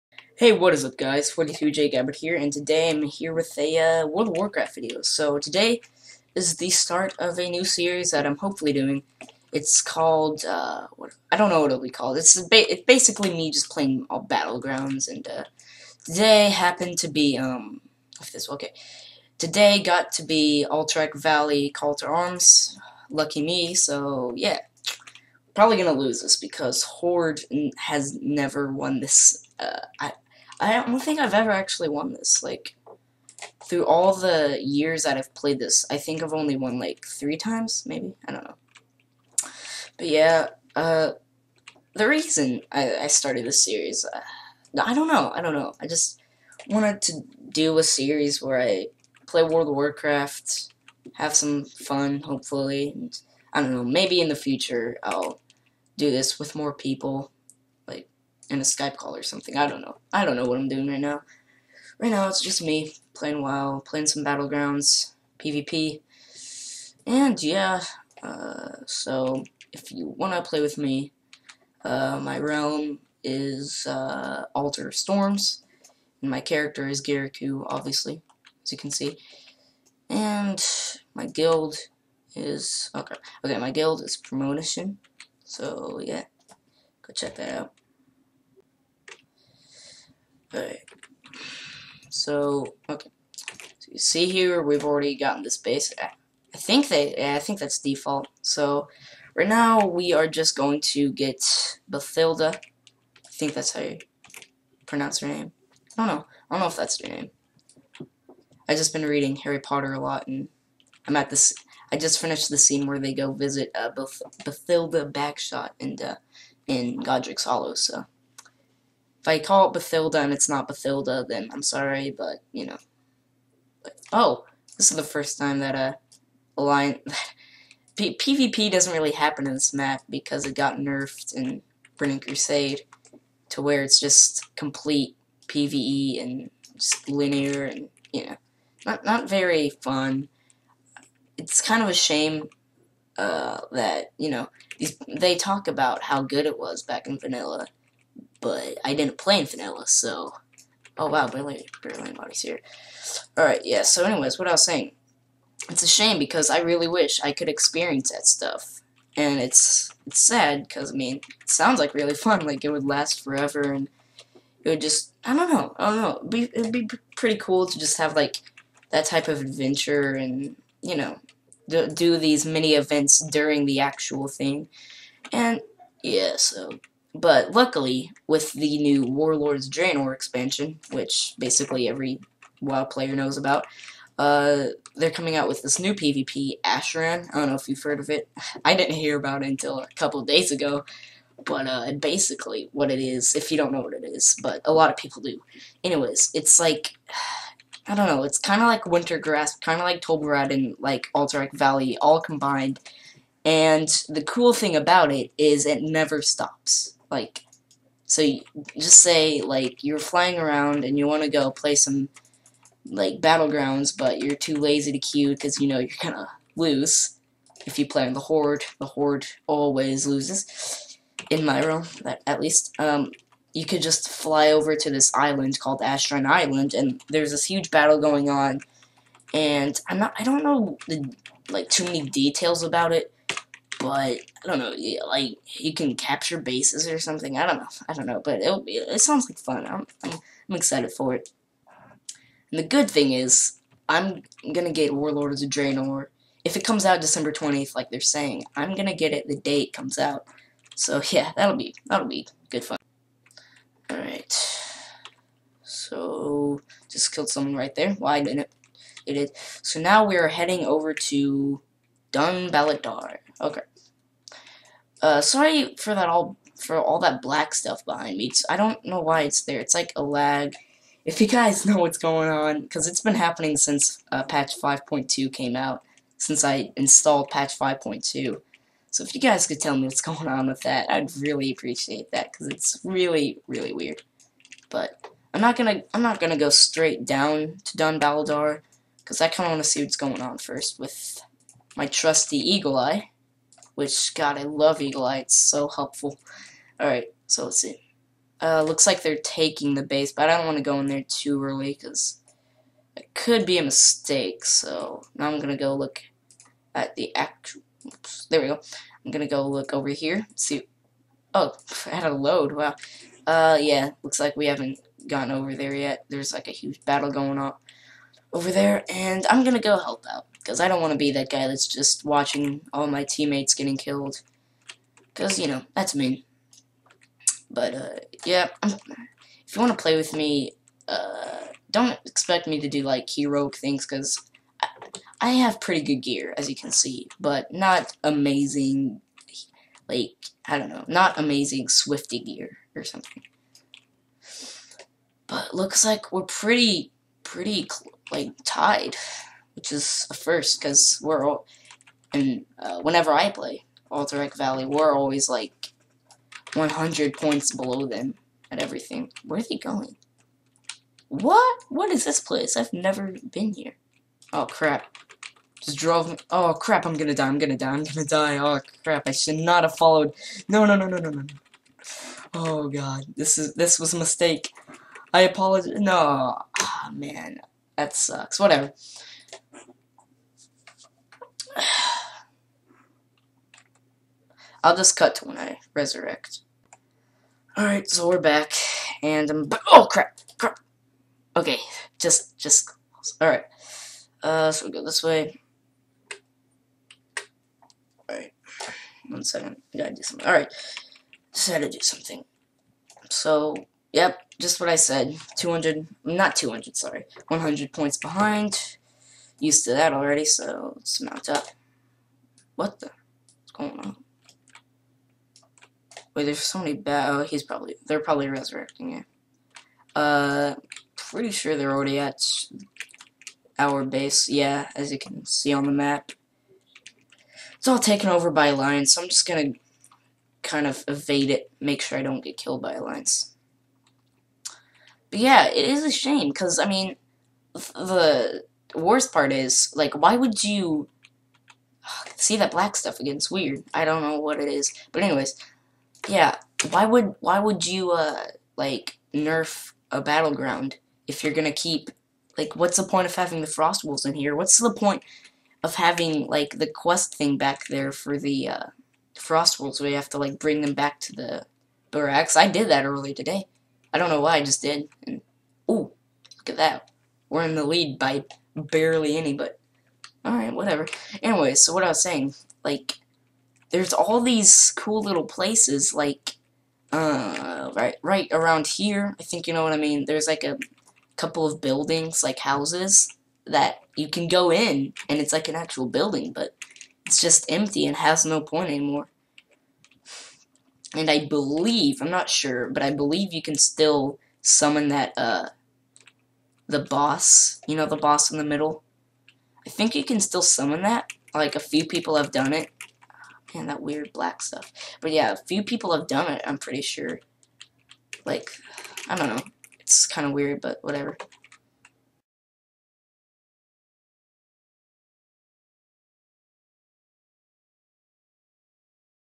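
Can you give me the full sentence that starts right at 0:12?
It's, ba it's basically me just playing all Battlegrounds, and uh, today happened to be, um, if this, okay.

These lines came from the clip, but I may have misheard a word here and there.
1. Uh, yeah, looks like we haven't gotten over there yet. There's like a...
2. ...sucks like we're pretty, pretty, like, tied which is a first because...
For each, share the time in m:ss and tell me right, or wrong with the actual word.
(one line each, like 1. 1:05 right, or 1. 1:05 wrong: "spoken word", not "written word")
1. 5:13 right
2. 5:45 wrong: "looks", not "sucks".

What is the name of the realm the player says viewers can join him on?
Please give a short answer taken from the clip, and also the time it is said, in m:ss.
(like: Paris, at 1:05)
Altar Storms, at 1:14.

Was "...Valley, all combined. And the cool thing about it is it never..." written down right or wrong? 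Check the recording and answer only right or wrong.
right.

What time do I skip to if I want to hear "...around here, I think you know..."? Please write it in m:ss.
7:58.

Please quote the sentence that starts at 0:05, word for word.
So today is the start of a new series that I'm hopefully doing.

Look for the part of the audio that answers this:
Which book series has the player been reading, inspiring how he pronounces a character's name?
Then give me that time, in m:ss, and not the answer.
1:49.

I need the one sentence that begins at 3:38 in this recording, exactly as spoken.
The Horde always loses, in my realm, at, least.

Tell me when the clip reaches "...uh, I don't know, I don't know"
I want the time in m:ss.
0:44.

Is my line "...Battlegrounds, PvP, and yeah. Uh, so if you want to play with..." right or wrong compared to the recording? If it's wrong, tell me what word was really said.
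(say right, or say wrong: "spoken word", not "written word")
right.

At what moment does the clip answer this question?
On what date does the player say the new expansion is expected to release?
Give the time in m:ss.
4:07.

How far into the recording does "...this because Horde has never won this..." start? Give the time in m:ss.
0:26.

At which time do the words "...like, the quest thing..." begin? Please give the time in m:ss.
7:36.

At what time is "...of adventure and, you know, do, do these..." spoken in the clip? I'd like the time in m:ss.
2:49.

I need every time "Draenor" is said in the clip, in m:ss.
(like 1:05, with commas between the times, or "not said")
2:59, 4:05.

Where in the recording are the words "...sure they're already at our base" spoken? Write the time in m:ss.
7:01.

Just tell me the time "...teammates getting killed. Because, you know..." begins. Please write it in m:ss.
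5:23.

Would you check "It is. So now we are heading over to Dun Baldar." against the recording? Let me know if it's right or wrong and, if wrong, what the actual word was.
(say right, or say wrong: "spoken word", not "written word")
right.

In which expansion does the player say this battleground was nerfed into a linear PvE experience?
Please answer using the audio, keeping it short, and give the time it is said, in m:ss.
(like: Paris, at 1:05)
Burning Crusade, at 2:11.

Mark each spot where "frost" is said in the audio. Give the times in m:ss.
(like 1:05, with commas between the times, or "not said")
7:33, 7:39.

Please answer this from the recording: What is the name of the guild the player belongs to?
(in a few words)
Promotion.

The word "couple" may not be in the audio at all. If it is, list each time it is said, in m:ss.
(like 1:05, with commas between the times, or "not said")
3:09, 8:01.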